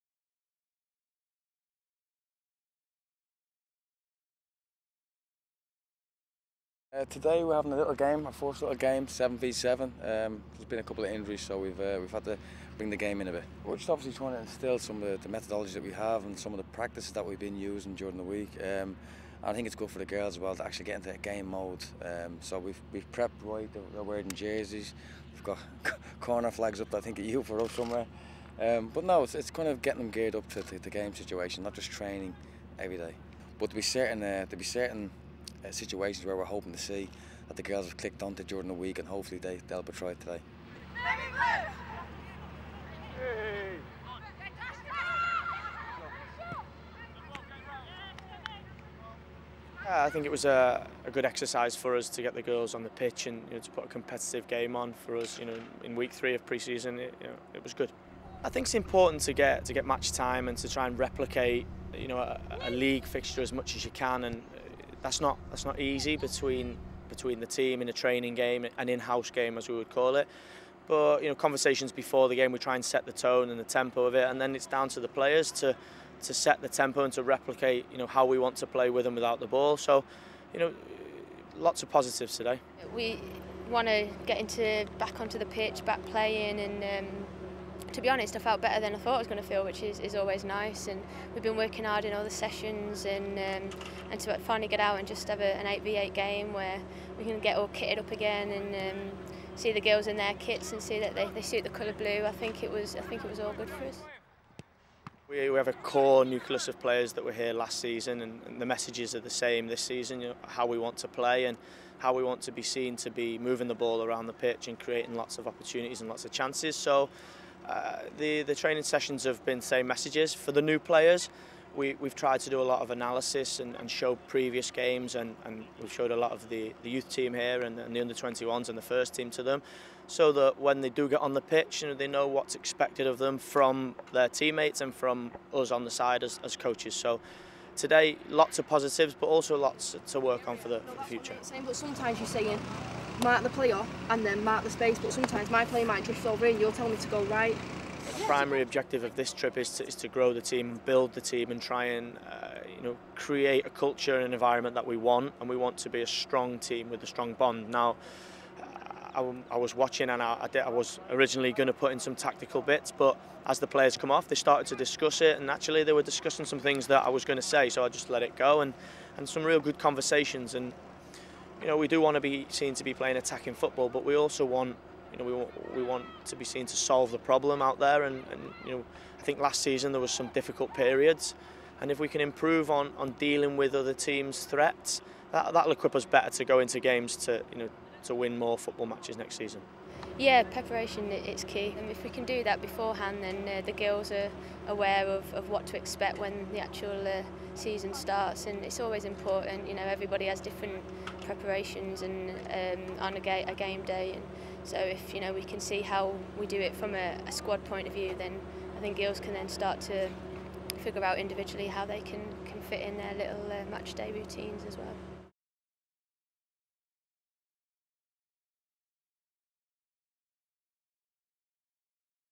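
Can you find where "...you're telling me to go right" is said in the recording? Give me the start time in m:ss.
2:26.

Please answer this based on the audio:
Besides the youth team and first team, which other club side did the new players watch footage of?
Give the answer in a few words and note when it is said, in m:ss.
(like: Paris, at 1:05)
Under-21s, at 2:08.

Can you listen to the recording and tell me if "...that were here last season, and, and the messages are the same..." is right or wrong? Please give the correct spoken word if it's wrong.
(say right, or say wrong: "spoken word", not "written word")
right.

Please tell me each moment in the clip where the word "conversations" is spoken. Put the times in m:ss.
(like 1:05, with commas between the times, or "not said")
1:11, 2:49.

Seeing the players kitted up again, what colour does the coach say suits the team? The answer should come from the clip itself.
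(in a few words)
Blue.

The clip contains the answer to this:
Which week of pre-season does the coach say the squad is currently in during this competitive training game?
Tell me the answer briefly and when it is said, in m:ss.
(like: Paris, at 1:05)
3, at 0:56.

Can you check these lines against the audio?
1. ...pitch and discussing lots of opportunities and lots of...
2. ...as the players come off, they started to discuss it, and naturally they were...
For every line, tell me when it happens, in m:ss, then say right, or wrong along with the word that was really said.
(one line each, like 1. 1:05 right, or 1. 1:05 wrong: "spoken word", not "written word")
1. 1:54 wrong: "creating", not "discussing"
2. 2:43 right.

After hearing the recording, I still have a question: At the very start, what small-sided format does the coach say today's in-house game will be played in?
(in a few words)
7v7.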